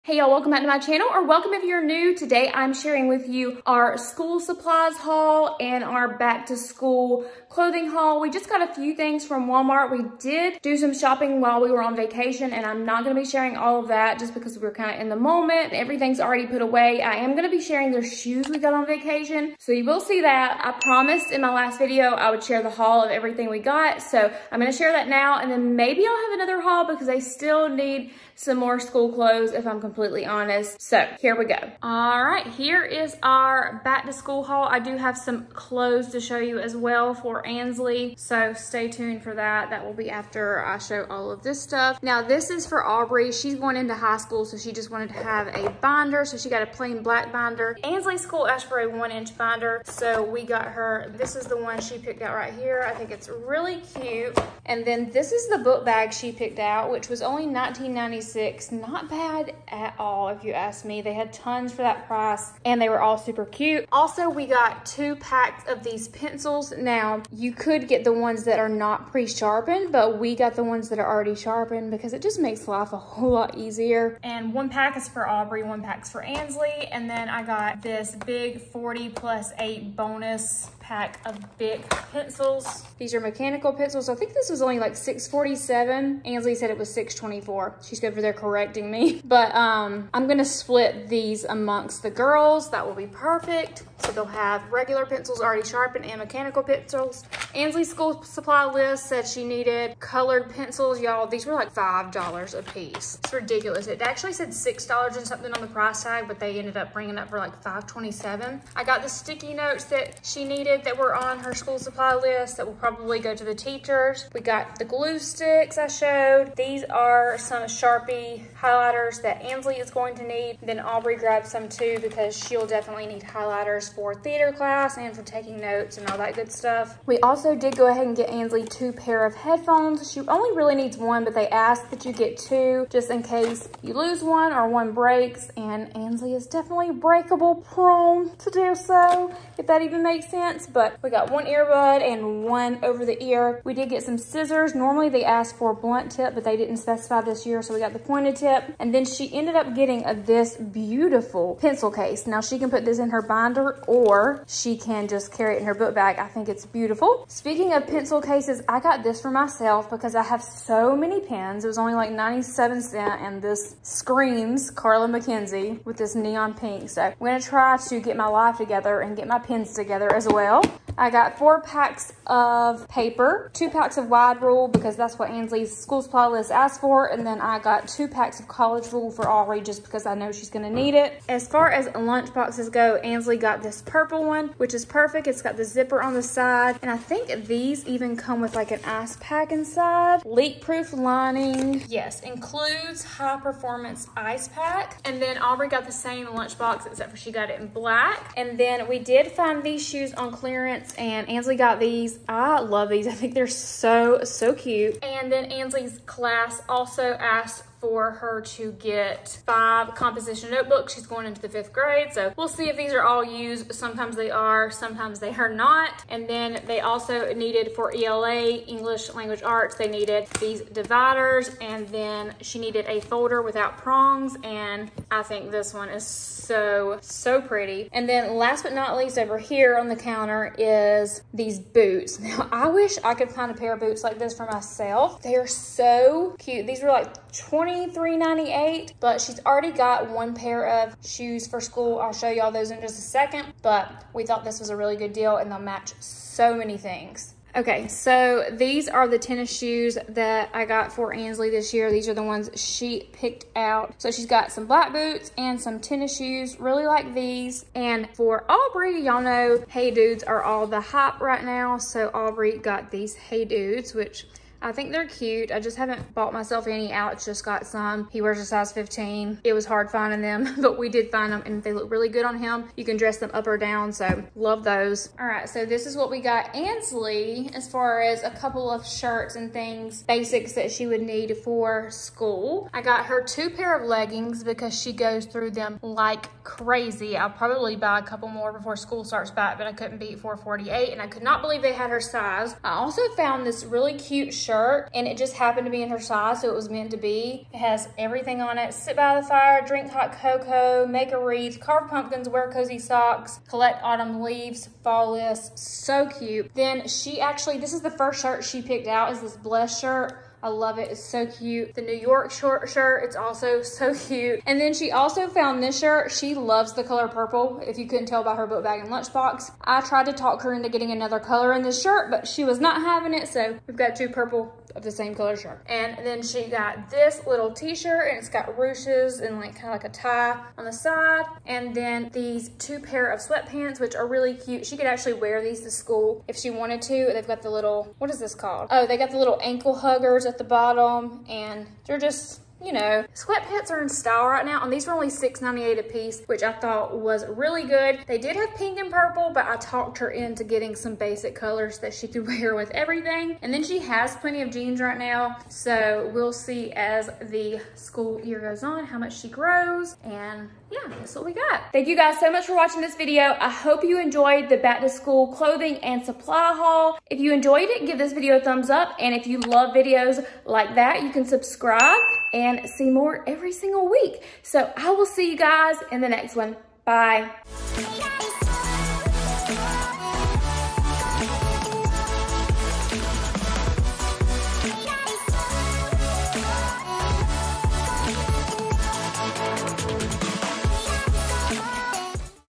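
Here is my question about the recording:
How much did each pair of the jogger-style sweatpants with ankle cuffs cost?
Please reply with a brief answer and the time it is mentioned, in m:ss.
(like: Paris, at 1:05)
$6.98, at 5:45.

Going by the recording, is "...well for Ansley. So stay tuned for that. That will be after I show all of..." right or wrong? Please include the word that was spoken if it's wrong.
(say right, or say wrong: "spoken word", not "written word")
right.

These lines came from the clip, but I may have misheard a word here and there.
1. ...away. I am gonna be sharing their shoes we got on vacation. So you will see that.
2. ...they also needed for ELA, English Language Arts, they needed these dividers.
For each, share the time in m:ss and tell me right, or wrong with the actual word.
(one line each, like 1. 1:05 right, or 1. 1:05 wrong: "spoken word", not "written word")
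1. 0:16 right
2. 3:36 right.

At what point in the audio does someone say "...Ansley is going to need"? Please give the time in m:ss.
1:59.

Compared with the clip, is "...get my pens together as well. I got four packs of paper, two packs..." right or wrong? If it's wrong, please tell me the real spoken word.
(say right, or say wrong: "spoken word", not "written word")
right.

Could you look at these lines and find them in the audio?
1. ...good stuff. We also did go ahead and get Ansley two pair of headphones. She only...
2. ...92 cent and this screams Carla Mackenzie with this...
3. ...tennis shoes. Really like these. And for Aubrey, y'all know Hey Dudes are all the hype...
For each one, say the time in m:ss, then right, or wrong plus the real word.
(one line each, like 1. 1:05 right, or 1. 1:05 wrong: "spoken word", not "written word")
1. 2:06 right
2. 2:42 wrong: "97", not "92"
3. 4:15 right.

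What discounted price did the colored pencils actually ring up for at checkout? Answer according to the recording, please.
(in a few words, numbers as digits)
$5.27.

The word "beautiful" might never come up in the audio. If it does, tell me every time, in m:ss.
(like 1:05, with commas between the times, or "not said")
2:30, 2:36.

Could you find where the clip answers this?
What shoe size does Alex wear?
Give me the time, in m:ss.
4:28.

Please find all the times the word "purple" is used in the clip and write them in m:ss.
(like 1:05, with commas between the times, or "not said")
3:03, 5:17, 5:24, 5:48.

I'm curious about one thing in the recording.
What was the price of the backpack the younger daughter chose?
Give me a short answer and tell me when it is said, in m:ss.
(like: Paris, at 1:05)
$19.96, at 0:57.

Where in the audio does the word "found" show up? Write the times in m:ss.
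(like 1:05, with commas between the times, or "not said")
4:53, 5:15.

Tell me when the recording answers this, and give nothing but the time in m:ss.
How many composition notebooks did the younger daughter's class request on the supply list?
3:29.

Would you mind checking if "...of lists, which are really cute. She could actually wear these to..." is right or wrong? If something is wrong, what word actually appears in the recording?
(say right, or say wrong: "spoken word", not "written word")
wrong: "sweatpants", not "lists".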